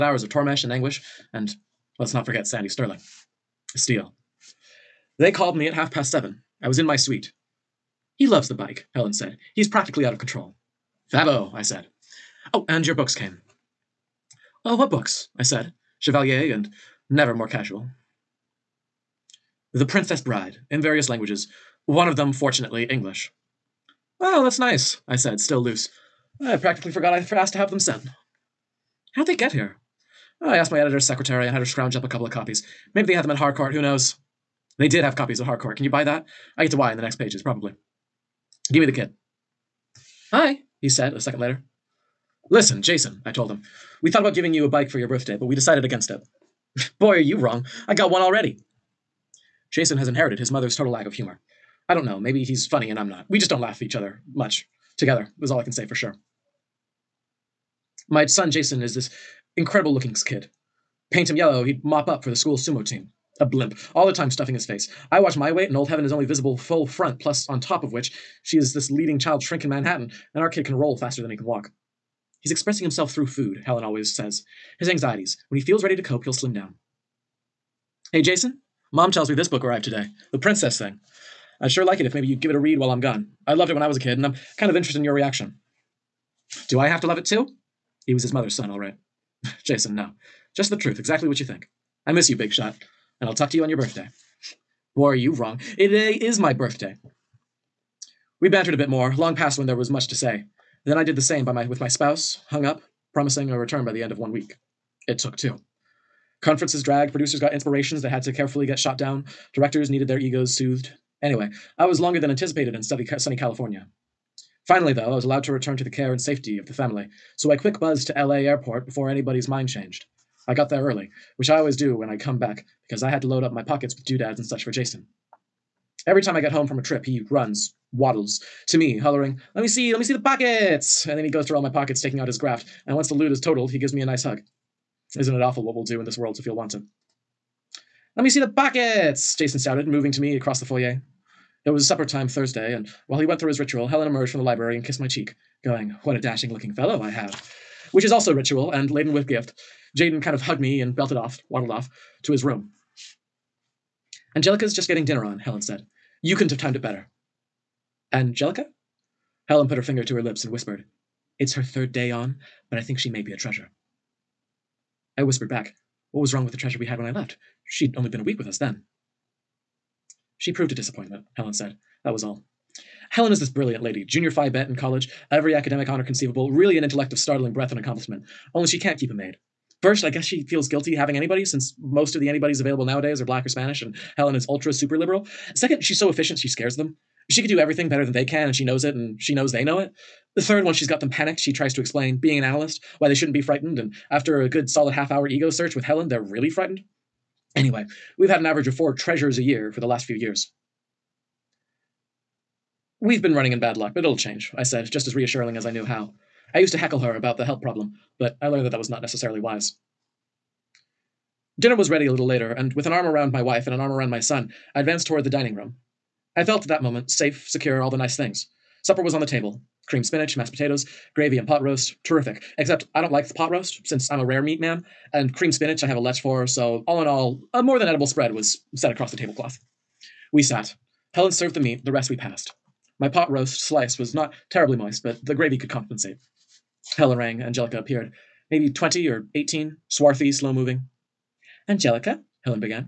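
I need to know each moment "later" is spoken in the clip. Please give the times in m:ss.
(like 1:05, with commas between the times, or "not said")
0:41, 3:32.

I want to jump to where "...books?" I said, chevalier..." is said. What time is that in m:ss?
0:14.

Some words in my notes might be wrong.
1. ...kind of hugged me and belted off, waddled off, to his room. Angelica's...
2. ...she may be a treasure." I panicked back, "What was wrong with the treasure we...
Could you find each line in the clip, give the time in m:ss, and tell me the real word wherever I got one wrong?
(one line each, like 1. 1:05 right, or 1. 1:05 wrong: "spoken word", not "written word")
1. 2:30 right
2. 2:42 wrong: "whispered", not "panicked".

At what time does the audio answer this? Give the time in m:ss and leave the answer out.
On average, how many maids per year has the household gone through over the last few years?
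3:18.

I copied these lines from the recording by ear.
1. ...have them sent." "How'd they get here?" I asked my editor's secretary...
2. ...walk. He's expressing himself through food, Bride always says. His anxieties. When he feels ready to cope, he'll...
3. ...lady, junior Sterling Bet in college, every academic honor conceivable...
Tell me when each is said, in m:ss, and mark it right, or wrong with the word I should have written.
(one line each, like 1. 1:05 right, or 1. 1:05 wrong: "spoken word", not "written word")
1. 0:27 right
2. 1:11 wrong: "Helen", not "Bride"
3. 2:53 wrong: "Phi", not "Sterling".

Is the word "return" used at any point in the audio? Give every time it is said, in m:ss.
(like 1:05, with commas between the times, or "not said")
1:43, 1:55.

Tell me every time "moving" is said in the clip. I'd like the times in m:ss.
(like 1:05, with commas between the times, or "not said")
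2:19, 4:00.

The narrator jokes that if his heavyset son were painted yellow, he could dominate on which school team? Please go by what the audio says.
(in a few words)
sumo team.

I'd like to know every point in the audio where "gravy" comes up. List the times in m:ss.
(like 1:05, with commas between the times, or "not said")
3:41, 3:55.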